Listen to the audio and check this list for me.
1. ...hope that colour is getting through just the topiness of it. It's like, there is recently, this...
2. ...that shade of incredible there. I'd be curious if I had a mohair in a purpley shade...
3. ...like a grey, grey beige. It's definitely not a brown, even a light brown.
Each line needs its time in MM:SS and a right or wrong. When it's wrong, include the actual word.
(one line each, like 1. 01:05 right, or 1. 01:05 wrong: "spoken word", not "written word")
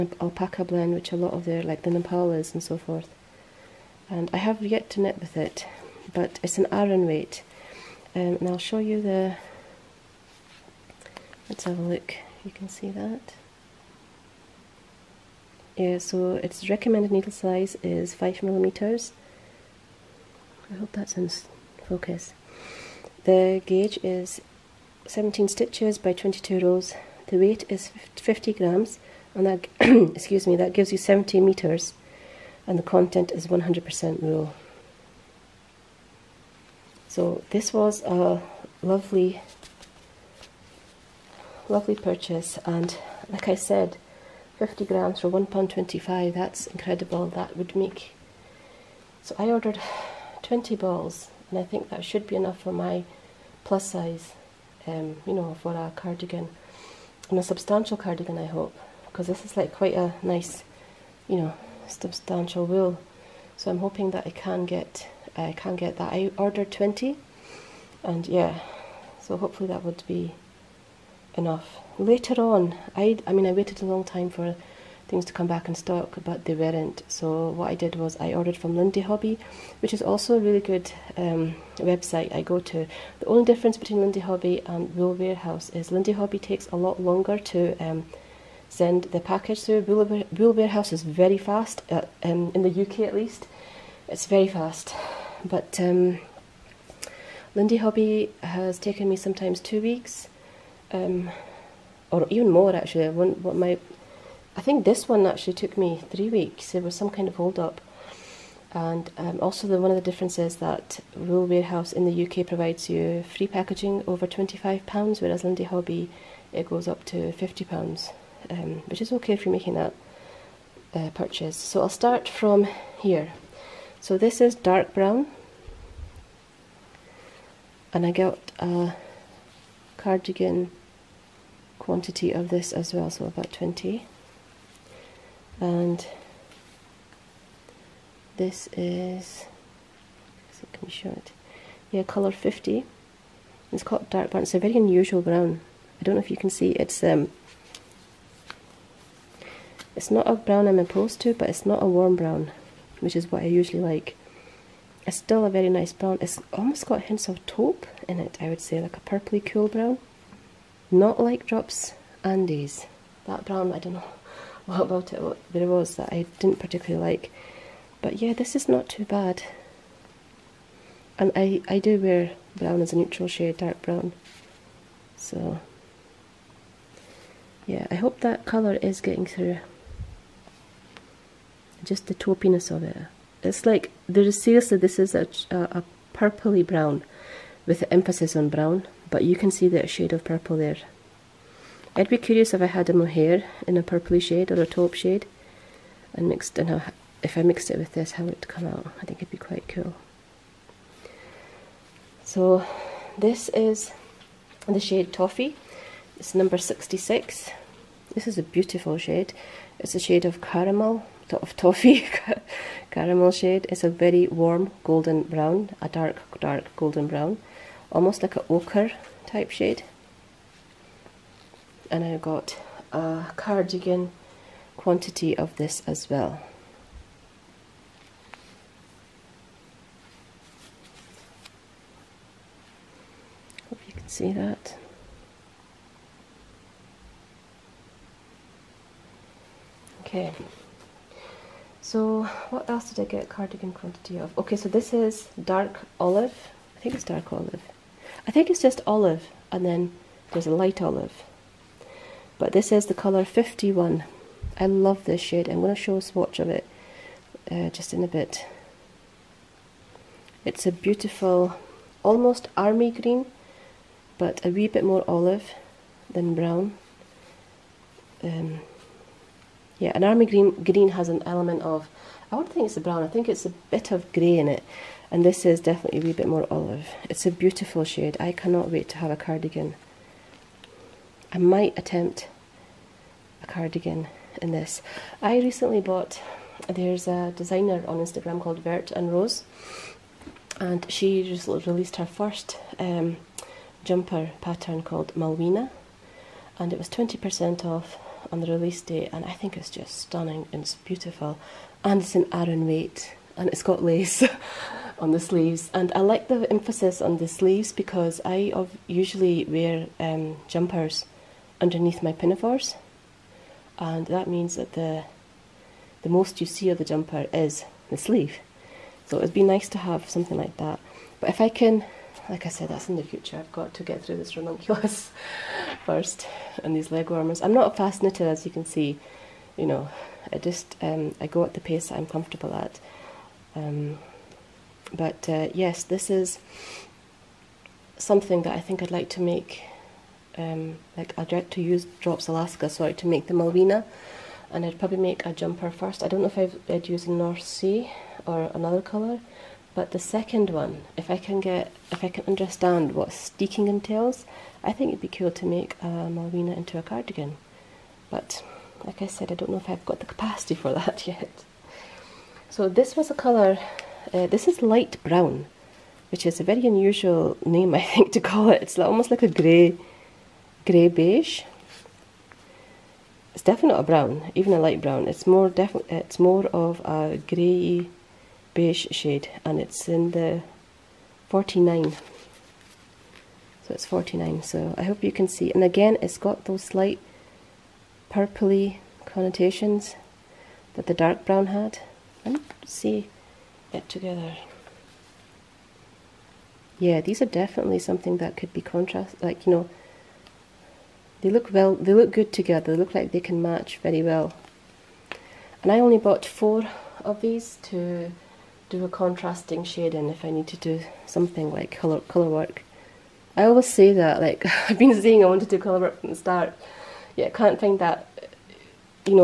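1. 02:57 wrong: "seriously", not "recently"
2. 03:09 wrong: "purple", not "incredible"
3. 06:09 right.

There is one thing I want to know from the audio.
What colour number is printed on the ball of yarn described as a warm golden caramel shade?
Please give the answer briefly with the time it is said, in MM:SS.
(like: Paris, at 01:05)
66, at 03:26.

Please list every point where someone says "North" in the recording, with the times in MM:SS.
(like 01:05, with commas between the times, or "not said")
05:47.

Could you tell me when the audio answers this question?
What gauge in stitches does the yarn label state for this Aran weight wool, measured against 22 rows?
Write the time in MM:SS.
00:25.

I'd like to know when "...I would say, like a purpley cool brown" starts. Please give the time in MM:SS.
02:38.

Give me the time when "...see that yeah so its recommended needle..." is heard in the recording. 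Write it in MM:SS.
00:12.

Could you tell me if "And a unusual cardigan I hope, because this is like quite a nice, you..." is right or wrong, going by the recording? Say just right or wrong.
wrong.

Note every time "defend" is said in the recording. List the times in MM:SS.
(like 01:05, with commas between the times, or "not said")
not said.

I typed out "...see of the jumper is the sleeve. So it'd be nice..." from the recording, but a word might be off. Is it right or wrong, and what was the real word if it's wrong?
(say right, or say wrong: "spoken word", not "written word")
right.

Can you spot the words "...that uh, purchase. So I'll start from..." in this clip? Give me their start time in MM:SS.
01:59.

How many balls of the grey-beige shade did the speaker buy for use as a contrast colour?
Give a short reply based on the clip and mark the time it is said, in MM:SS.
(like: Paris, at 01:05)
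4, at 06:46.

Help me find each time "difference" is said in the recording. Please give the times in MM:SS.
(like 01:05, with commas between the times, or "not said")
01:23, 01:50.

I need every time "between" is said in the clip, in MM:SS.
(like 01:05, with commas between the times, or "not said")
01:23.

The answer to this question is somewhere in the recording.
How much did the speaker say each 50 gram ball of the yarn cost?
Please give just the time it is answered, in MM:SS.
00:45.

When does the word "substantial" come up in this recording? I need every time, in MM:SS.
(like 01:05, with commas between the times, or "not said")
00:57, 01:01.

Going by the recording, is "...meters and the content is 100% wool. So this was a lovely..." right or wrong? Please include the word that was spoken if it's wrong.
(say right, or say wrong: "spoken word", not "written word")
right.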